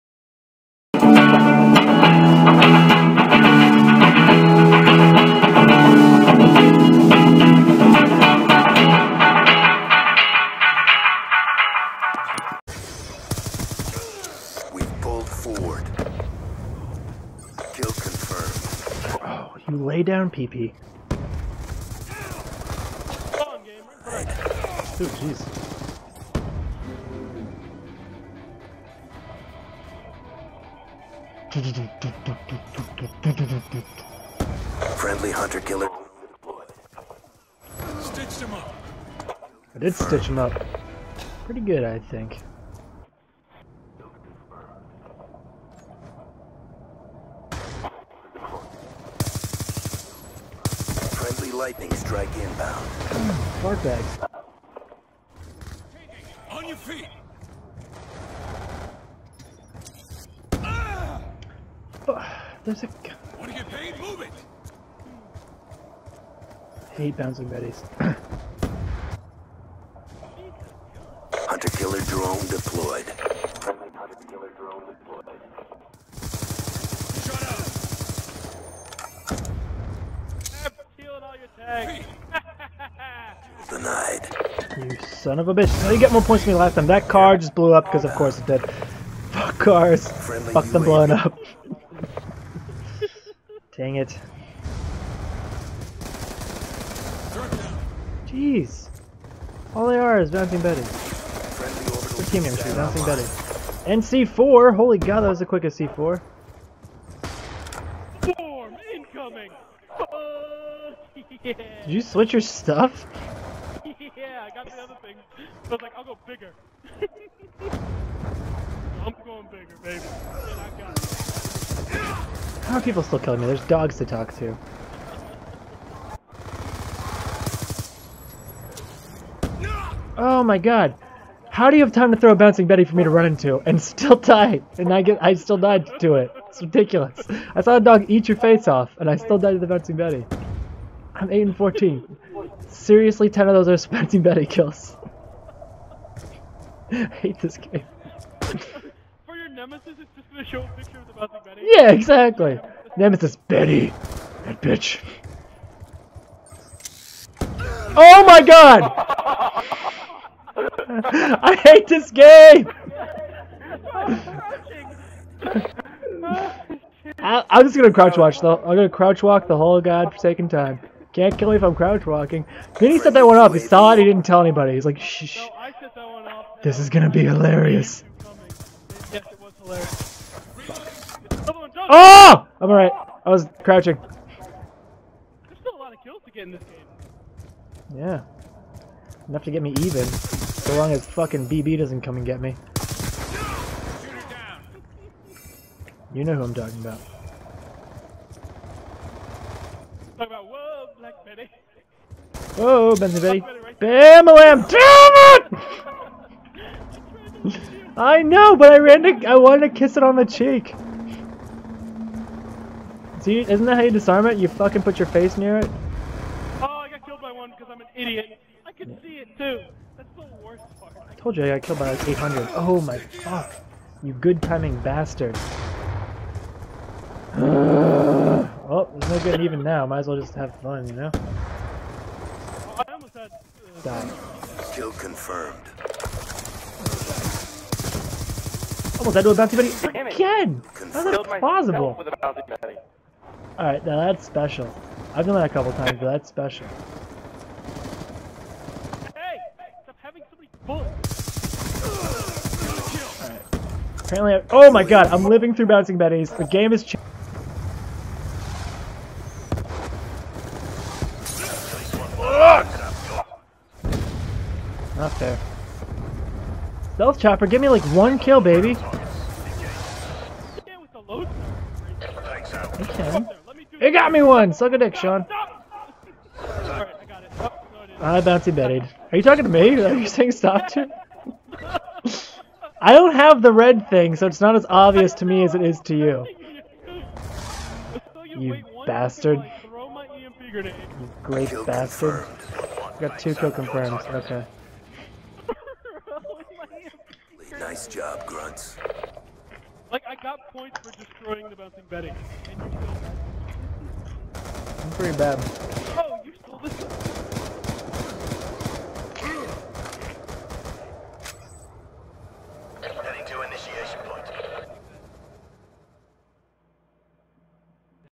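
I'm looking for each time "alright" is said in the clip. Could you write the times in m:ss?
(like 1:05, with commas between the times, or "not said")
3:02, 4:03.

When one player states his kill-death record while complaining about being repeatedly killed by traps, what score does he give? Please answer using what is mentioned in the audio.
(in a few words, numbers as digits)
8 and 14.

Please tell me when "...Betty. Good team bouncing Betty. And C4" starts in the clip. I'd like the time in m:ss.
1:40.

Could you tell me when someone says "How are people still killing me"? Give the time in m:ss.
2:02.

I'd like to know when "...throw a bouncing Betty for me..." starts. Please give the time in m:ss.
2:12.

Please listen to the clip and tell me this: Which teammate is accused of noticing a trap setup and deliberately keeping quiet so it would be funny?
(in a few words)
Vinny.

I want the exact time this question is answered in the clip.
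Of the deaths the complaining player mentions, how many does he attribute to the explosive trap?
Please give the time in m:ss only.
2:23.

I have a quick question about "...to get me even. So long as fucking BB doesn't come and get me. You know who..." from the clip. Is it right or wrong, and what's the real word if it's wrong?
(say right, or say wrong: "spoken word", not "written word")
right.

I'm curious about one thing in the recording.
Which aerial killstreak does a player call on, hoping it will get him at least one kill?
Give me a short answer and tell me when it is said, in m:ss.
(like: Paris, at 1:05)
Stealth chopper, at 4:26.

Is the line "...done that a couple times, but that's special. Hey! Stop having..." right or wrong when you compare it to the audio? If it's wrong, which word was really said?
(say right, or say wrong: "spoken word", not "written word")
right.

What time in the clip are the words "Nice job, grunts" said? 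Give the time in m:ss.
4:57.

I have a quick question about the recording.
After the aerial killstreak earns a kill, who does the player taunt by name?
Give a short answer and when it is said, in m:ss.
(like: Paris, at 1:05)
Sean, at 4:34.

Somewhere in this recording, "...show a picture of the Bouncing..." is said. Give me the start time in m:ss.
2:30.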